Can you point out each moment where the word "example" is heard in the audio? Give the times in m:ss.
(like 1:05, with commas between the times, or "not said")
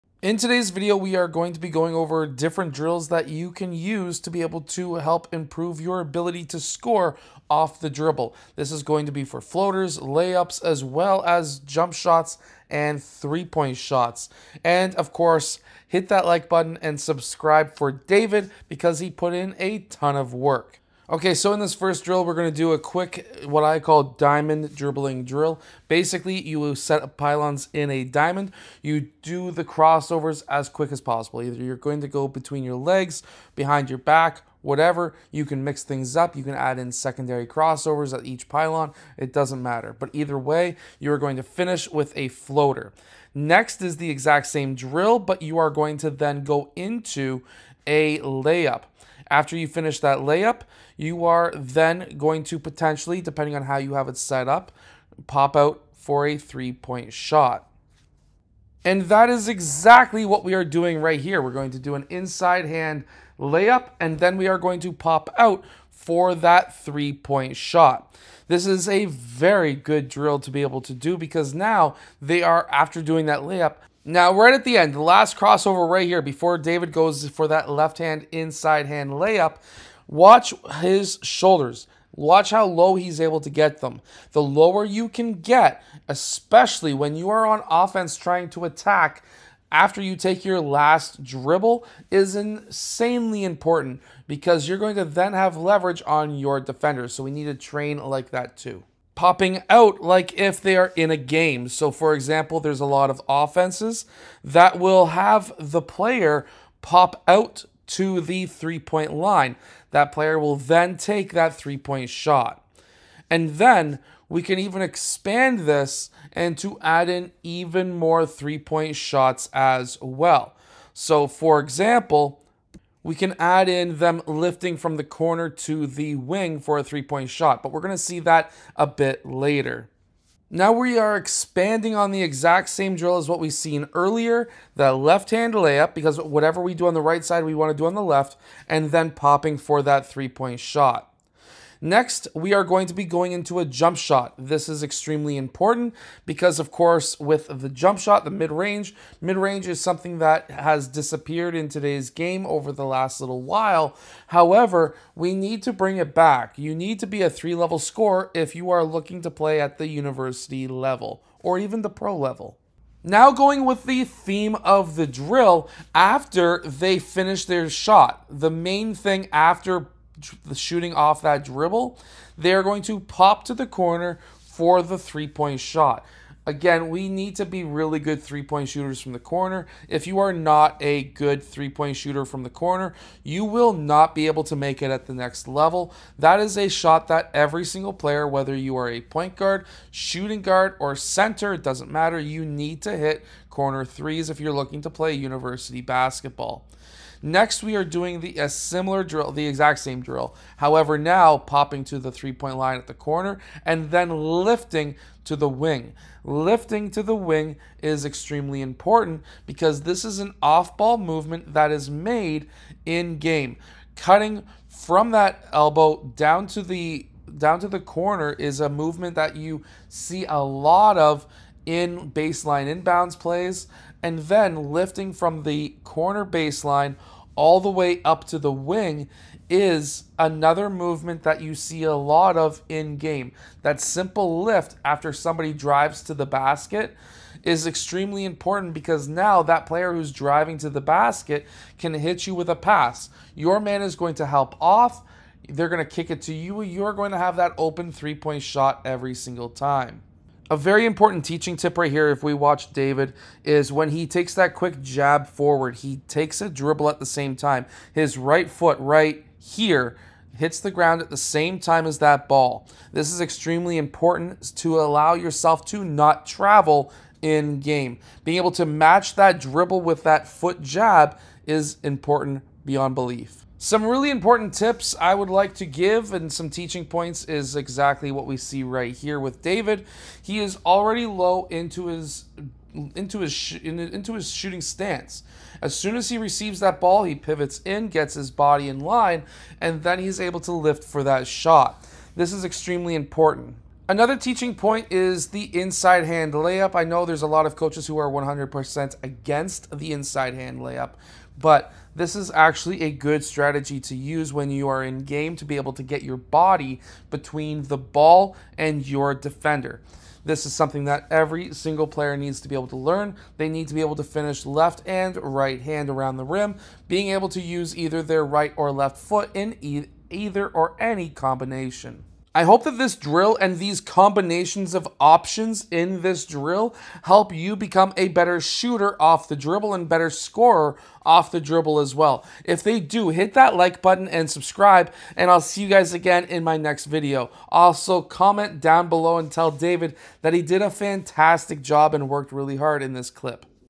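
1:42, 2:01.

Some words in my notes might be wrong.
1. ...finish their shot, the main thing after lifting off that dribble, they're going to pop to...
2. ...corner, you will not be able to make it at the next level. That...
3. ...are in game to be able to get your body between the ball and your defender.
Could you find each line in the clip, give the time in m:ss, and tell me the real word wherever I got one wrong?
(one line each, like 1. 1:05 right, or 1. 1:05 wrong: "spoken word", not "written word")
1. 2:46 wrong: "shooting", not "lifting"
2. 3:02 right
3. 5:04 right.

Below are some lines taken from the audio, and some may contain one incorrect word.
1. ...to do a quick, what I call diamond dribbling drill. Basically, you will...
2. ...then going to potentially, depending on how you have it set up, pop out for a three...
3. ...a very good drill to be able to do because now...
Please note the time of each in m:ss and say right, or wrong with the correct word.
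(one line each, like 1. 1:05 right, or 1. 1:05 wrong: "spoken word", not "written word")
1. 0:22 right
2. 0:51 right
3. 1:08 right.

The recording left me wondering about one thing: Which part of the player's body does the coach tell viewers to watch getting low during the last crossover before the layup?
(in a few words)
Shoulders.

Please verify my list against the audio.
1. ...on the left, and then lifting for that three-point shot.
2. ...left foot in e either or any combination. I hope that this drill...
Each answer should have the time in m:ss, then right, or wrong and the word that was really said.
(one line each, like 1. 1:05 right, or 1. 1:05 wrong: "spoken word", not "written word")
1. 2:17 wrong: "popping", not "lifting"
2. 5:18 right.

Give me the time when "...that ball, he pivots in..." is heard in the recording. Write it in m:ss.
4:46.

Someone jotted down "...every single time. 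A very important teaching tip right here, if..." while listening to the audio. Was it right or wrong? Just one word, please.
right.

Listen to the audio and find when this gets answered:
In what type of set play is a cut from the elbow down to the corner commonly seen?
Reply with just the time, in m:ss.
3:42.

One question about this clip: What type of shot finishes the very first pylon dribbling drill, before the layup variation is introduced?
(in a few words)
Floater.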